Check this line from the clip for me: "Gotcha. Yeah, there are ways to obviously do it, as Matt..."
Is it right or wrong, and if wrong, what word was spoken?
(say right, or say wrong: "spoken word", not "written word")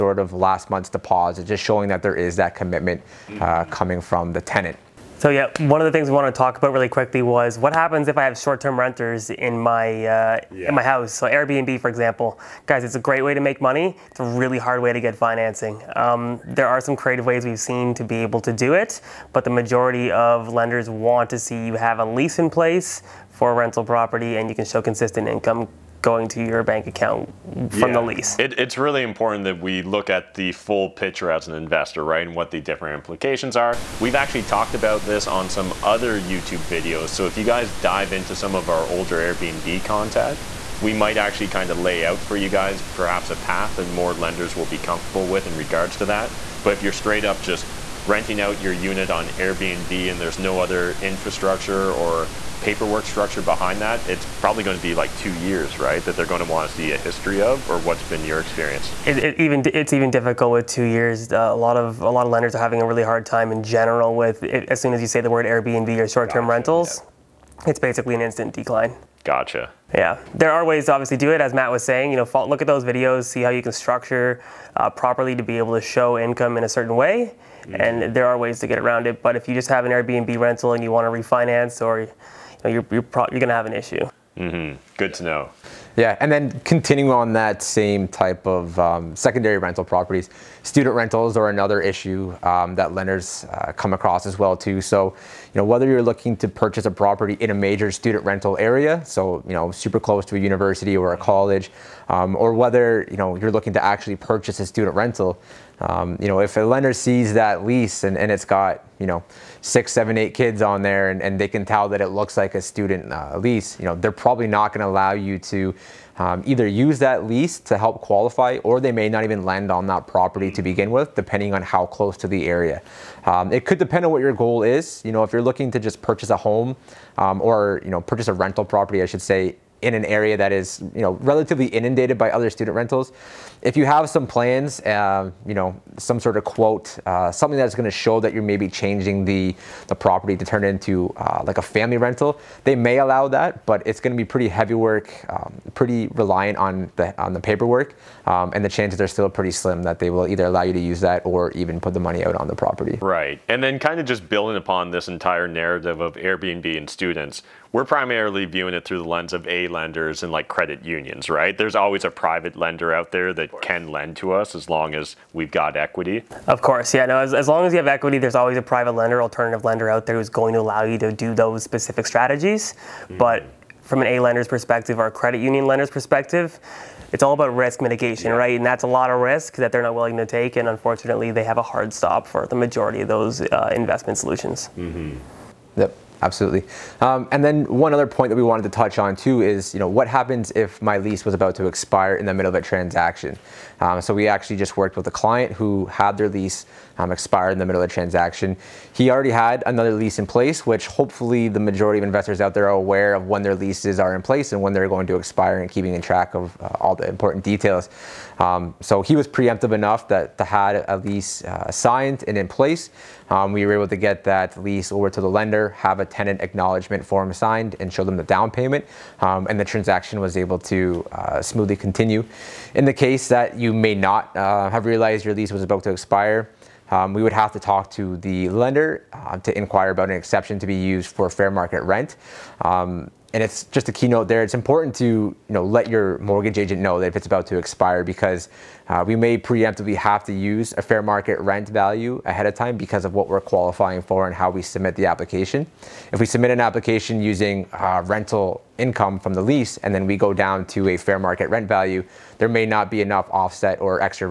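right.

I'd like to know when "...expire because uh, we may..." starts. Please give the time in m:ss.
3:57.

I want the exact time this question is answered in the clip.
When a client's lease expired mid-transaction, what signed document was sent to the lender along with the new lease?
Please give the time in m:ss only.
3:36.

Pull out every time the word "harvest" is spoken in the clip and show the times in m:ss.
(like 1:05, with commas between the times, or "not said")
not said.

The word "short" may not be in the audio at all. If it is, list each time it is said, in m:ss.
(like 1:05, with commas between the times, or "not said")
0:08, 1:06.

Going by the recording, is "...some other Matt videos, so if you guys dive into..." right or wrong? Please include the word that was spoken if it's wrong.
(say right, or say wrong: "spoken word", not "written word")
wrong: "YouTube", not "Matt".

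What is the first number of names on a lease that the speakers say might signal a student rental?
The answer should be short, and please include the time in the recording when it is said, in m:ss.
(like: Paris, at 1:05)
6, at 1:49.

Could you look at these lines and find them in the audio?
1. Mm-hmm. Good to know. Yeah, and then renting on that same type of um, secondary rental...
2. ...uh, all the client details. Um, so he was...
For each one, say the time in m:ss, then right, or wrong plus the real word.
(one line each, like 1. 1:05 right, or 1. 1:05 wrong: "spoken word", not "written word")
1. 1:24 wrong: "continuing", not "renting"
2. 3:26 wrong: "important", not "client".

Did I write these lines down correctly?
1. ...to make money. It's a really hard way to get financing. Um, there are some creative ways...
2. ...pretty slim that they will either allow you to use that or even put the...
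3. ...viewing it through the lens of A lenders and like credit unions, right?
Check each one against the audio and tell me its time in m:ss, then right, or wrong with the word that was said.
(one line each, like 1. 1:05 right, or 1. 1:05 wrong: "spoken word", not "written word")
1. 0:13 right
2. 2:29 right
3. 2:38 right.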